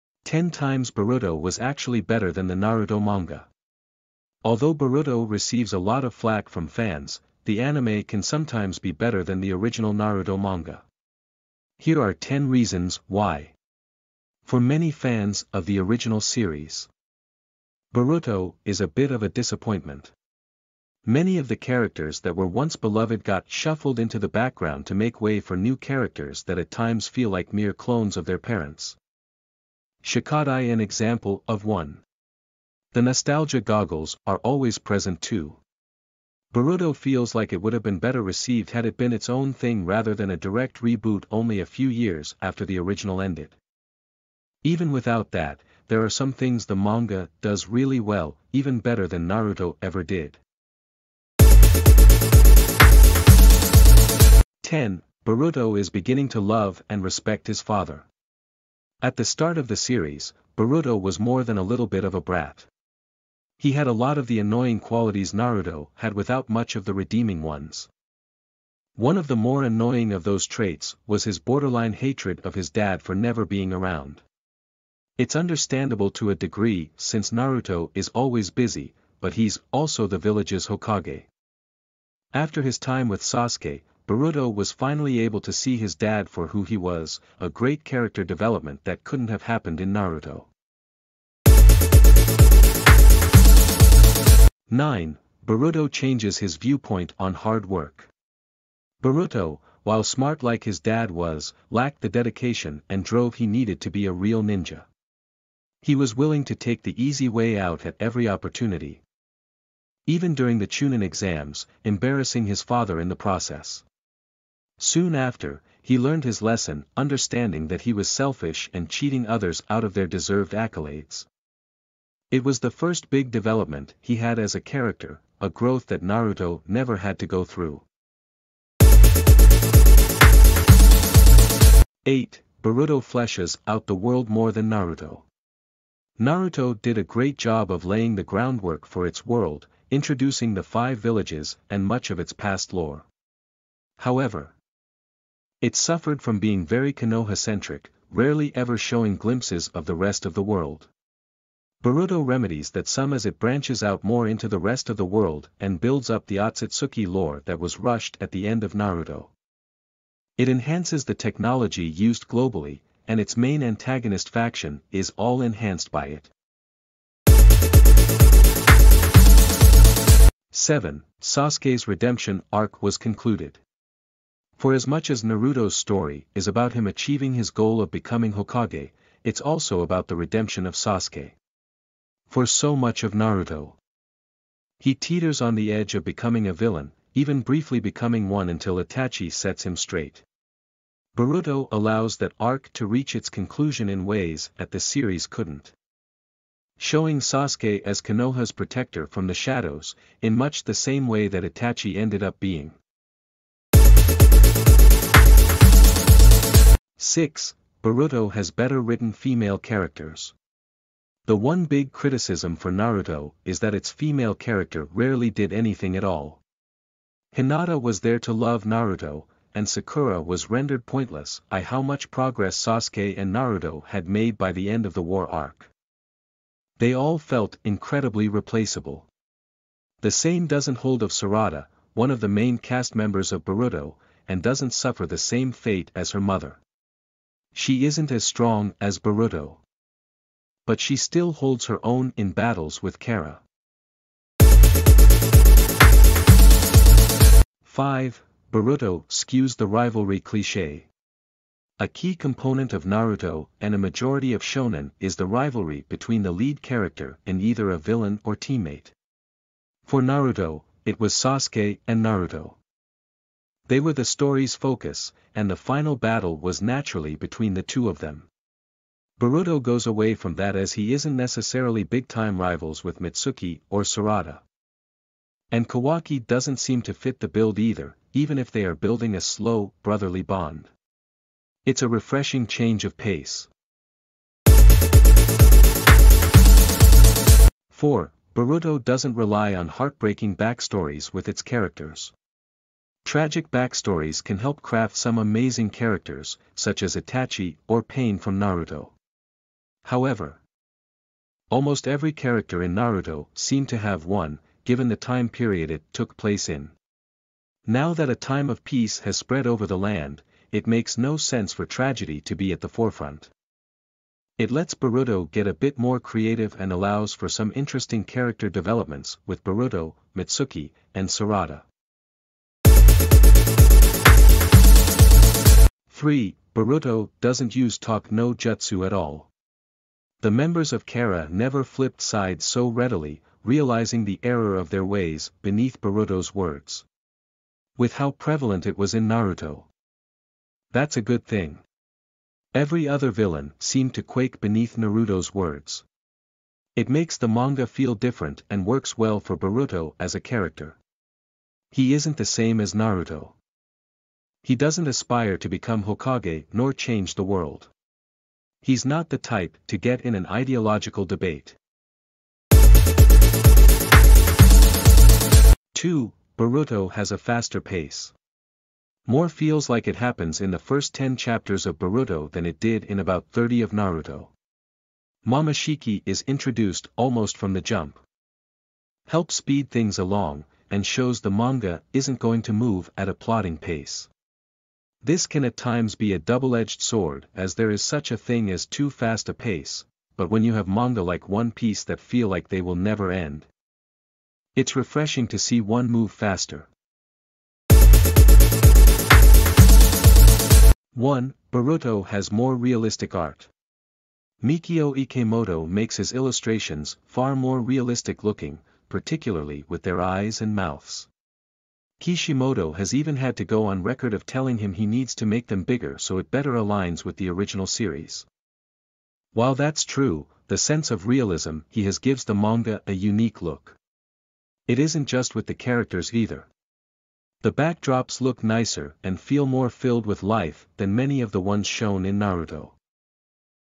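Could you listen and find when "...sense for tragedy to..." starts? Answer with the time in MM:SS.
05:11.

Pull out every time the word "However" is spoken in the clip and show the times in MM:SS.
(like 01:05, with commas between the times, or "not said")
02:23, 04:59.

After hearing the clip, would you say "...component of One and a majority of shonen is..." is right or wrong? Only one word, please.
wrong.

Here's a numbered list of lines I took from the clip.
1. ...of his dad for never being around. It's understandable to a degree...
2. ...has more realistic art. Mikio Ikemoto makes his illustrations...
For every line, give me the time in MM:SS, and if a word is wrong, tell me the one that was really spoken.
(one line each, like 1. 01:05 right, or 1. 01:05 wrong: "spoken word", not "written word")
1. 01:12 right
2. 06:42 right.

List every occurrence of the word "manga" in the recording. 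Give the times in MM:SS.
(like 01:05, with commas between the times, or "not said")
00:03, 00:10, 00:46, 05:47, 06:21, 06:30, 07:02.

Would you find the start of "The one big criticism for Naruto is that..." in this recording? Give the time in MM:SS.
03:31.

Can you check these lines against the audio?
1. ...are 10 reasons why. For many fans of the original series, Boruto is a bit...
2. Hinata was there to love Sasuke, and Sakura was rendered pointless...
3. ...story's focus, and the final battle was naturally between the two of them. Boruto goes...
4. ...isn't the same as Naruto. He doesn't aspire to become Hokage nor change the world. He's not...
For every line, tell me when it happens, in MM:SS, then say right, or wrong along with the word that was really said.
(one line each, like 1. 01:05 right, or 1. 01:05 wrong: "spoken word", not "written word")
1. 00:11 right
2. 03:37 wrong: "Naruto", not "Sasuke"
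3. 04:24 right
4. 05:51 right.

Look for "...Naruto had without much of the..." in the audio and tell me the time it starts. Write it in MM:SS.
01:05.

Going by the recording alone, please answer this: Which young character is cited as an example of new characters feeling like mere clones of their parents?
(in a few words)
Shikadai.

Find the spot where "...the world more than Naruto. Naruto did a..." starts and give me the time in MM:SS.
02:13.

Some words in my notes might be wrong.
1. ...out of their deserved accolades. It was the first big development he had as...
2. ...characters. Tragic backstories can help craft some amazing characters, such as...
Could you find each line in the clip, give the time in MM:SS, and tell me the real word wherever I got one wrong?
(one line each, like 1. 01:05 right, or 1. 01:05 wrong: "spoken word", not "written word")
1. 01:59 right
2. 04:51 right.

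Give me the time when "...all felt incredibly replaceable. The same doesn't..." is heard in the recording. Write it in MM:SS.
03:46.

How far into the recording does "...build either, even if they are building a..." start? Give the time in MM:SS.
04:37.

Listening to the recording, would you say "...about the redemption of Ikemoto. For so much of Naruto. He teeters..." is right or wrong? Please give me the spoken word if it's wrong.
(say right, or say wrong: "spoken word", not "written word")
wrong: "Sasuke", not "Ikemoto".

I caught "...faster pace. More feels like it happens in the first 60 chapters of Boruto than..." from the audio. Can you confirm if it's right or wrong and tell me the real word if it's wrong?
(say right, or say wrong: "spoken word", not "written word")
wrong: "10", not "60".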